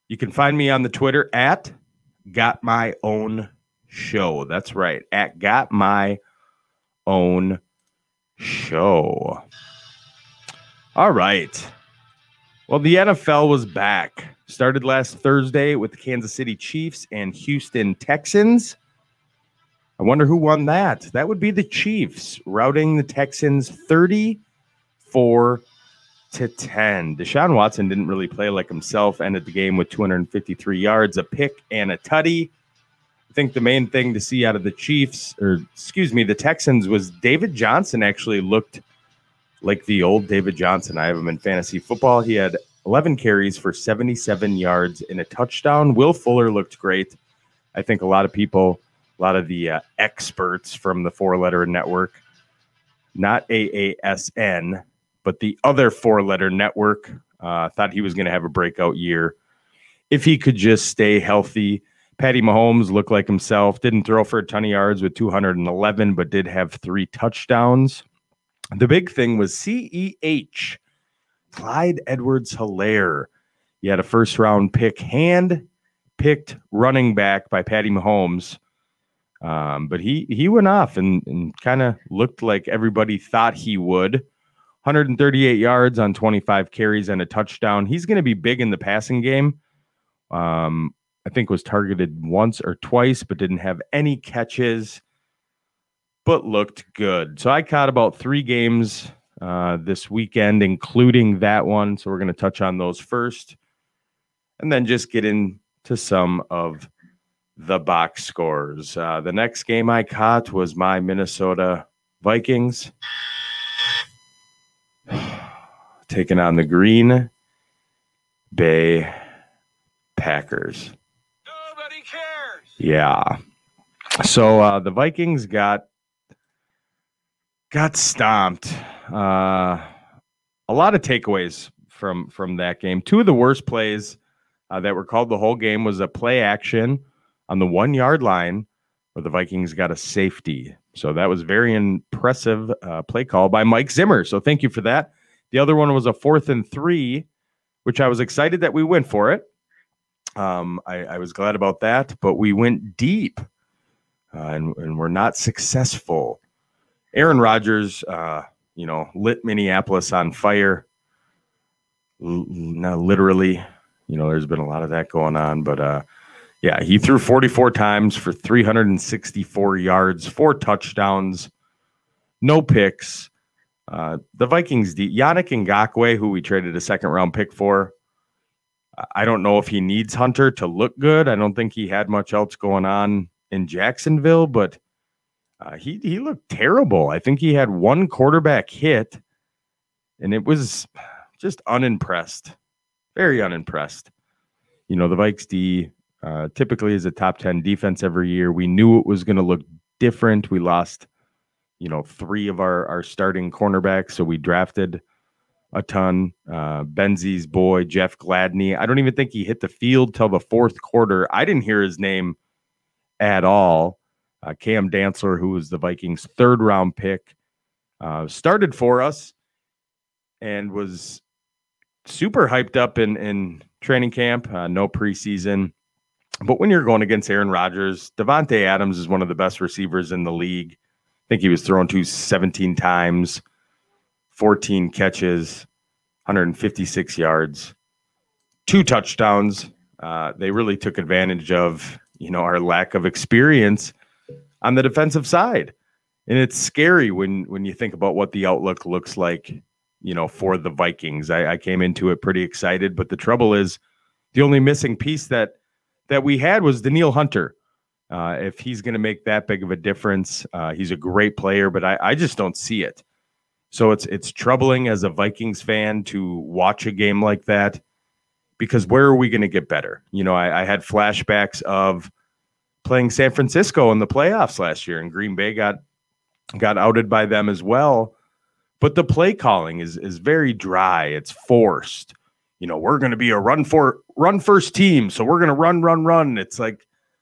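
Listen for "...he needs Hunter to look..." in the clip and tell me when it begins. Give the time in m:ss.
2:59.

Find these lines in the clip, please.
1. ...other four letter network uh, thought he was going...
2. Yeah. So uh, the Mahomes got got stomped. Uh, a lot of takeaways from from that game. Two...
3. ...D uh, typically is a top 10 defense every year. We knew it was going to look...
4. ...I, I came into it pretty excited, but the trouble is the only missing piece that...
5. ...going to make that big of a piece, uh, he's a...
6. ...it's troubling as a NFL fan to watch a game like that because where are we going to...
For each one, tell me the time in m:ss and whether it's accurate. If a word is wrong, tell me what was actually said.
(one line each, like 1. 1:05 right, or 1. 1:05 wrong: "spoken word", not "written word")
1. 0:55 right
2. 2:02 wrong: "Vikings", not "Mahomes"
3. 3:15 right
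4. 4:11 right
5. 4:18 wrong: "difference", not "piece"
6. 4:24 wrong: "Vikings", not "NFL".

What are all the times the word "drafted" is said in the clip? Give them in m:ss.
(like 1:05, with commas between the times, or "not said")
3:24.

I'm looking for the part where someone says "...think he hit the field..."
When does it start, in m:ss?
3:29.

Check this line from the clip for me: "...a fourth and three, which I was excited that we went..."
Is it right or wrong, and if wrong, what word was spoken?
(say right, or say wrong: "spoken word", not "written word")
right.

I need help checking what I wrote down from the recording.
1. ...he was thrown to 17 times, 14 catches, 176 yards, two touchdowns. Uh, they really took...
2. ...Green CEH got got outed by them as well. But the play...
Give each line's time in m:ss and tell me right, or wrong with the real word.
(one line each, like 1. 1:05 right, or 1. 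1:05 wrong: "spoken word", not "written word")
1. 3:51 wrong: "156", not "176"
2. 4:35 wrong: "Bay", not "CEH".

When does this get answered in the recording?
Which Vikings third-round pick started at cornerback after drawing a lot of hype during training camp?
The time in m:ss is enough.
3:34.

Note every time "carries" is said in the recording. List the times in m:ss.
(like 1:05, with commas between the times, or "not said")
0:43, 1:26.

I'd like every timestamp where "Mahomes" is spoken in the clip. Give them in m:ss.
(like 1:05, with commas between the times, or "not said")
1:02, 1:17.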